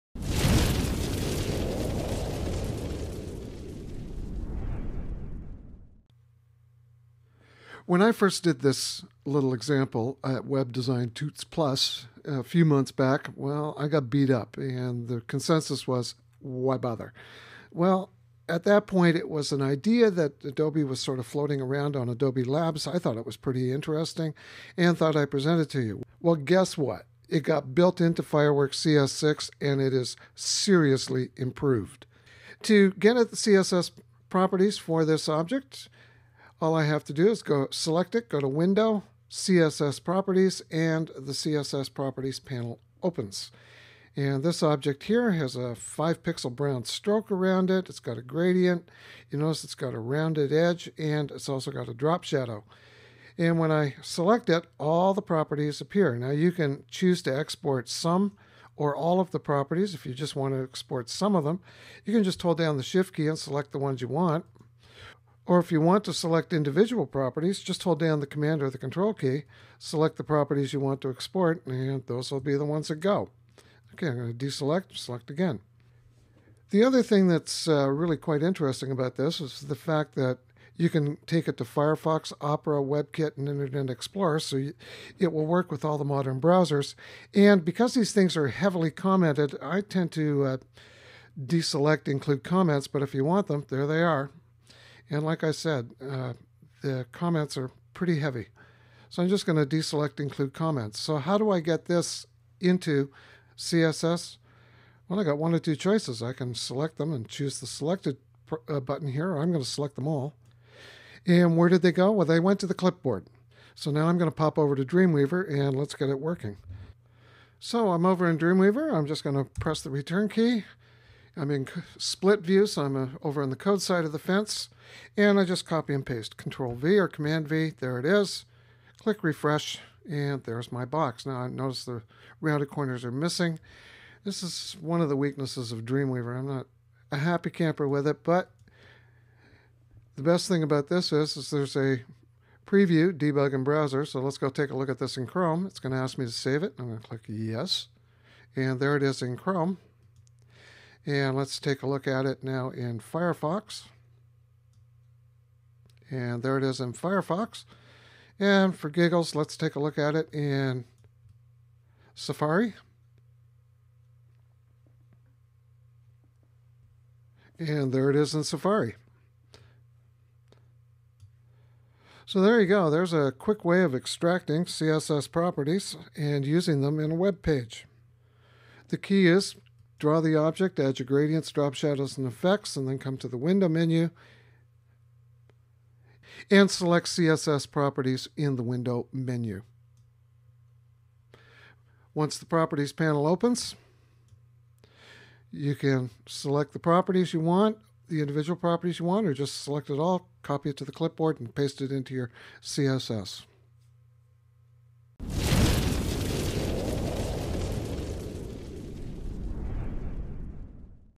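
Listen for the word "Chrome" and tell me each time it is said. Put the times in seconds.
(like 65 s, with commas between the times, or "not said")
145 s, 149 s.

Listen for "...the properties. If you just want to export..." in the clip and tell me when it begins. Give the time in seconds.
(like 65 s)
59 s.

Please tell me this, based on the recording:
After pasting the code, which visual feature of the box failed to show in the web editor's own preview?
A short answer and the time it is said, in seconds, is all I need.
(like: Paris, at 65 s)
rounded corners, at 132 s.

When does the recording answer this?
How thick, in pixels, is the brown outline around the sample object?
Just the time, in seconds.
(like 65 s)
45 s.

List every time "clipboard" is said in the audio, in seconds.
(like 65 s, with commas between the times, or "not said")
112 s, 200 s.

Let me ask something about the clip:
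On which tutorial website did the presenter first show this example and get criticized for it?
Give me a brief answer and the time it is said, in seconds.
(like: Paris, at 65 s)
Web Design Tuts Plus, at 10 s.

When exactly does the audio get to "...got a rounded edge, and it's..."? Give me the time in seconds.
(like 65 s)
49 s.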